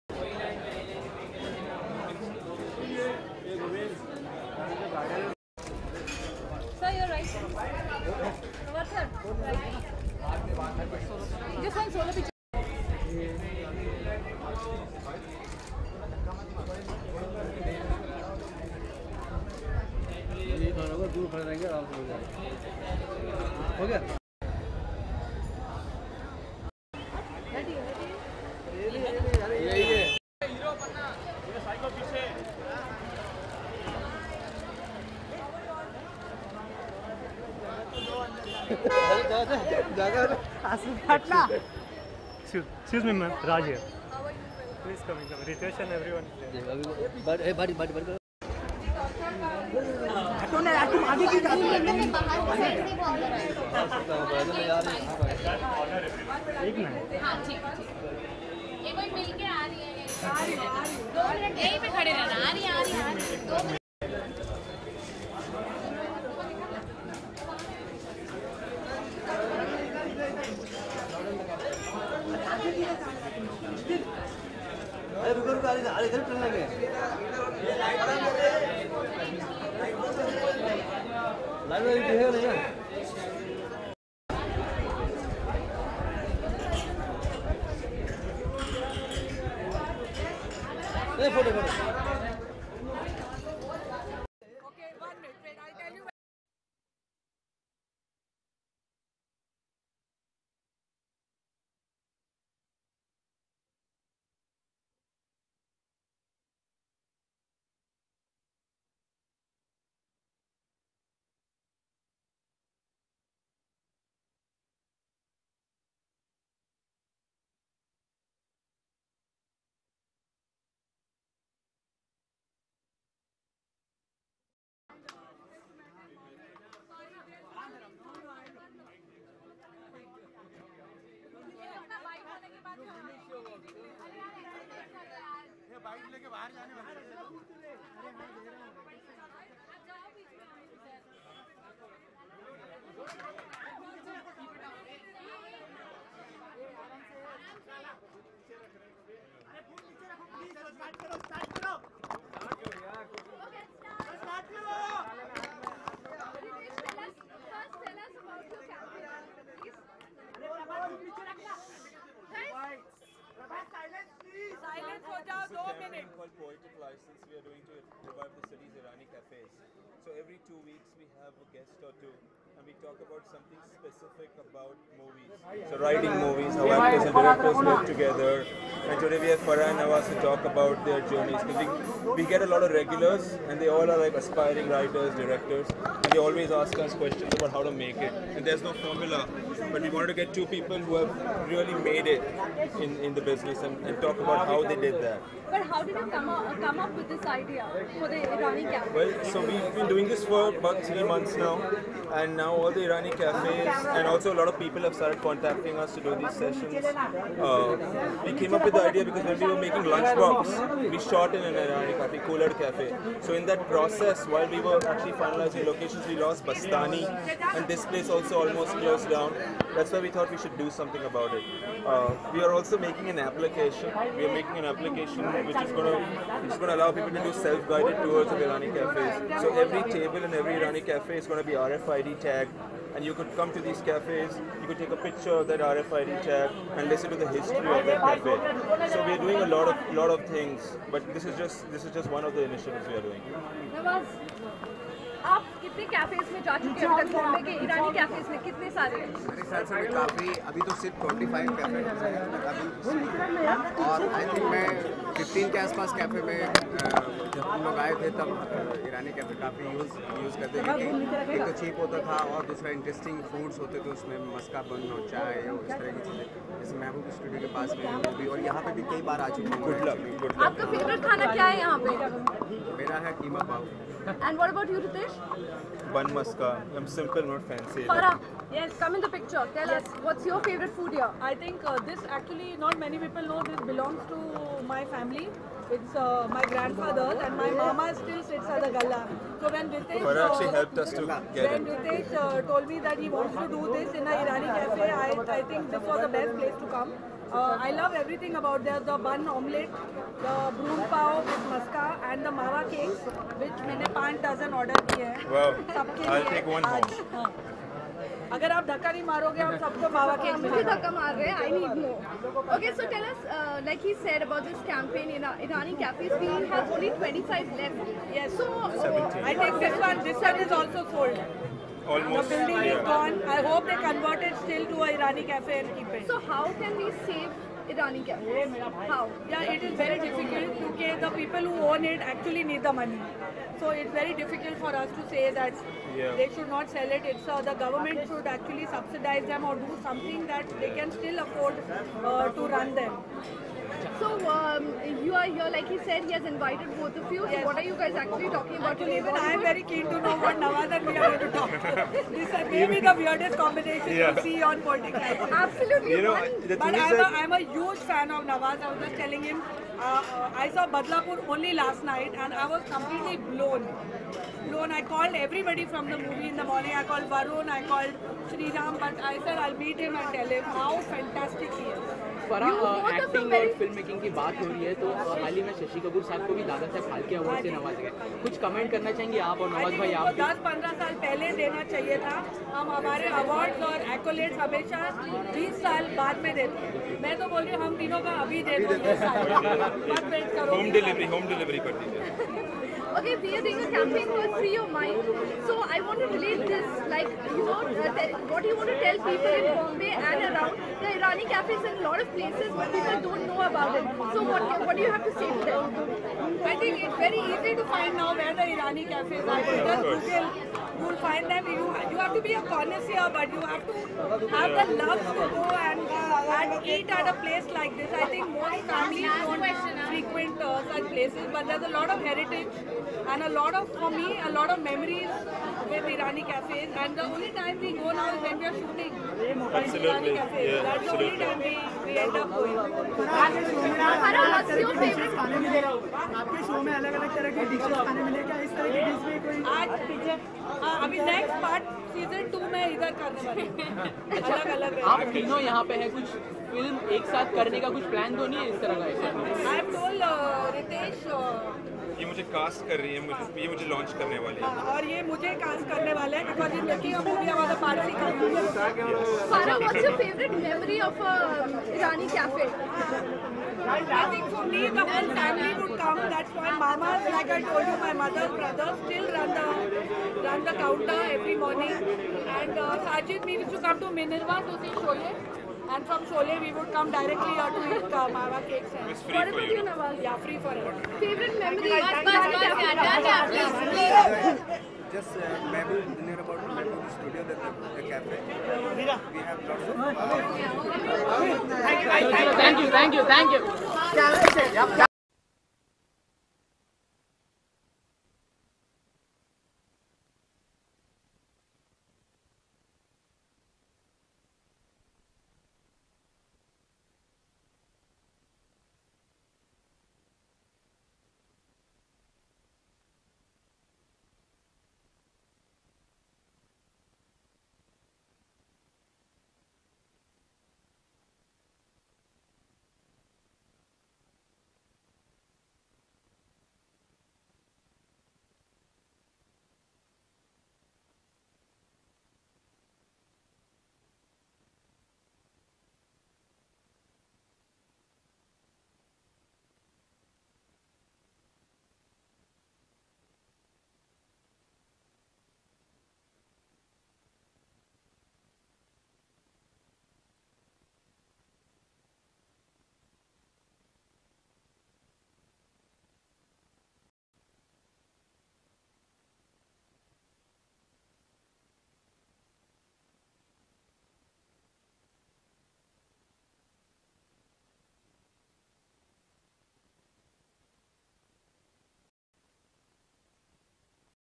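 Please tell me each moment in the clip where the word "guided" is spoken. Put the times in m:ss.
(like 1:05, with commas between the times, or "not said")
3:47.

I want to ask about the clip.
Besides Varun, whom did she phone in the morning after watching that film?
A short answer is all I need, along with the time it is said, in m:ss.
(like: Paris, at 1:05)
Sri Ram, at 6:08.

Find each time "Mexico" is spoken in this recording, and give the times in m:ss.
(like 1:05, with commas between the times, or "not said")
not said.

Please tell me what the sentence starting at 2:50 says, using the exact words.
So every two weeks we have a guest or two we talk about something specific about movies.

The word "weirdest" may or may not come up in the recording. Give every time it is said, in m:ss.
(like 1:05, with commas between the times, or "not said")
5:52.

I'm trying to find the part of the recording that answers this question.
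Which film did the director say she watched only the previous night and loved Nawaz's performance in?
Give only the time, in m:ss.
6:00.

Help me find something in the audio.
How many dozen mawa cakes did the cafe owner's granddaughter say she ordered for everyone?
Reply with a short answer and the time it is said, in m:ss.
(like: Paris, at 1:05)
5, at 5:03.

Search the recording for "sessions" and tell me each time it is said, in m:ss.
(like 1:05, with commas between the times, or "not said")
3:26.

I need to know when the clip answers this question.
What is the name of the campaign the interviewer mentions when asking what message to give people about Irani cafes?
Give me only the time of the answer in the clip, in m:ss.
6:34.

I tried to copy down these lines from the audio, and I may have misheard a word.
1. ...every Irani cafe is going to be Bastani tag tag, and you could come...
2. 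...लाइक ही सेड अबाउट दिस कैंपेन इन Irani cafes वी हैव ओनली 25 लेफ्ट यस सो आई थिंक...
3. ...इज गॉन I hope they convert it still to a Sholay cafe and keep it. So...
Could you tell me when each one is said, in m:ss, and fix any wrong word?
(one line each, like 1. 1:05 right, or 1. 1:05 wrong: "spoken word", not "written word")
1. 3:50 wrong: "RFID", not "Bastani"
2. 5:13 right
3. 5:22 wrong: "Irani", not "Sholay".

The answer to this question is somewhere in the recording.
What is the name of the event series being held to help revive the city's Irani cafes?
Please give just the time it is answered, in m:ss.
2:46.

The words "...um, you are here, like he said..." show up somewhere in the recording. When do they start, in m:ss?
5:44.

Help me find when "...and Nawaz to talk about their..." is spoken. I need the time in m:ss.
2:59.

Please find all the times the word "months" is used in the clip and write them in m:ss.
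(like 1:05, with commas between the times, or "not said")
3:21.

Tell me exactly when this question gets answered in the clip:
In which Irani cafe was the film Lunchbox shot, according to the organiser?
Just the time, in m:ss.
3:32.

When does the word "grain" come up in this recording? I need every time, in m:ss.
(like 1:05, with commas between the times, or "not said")
not said.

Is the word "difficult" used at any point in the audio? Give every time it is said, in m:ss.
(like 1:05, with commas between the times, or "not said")
5:29, 5:34.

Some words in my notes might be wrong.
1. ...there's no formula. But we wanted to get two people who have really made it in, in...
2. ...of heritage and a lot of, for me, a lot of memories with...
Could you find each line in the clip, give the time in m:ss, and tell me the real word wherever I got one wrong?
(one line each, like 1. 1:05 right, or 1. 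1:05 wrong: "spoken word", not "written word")
1. 3:08 right
2. 7:01 right.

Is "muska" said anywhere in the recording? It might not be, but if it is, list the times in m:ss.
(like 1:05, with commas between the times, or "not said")
4:36, 5:01.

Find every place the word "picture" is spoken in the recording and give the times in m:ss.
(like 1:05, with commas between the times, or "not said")
3:54, 4:39.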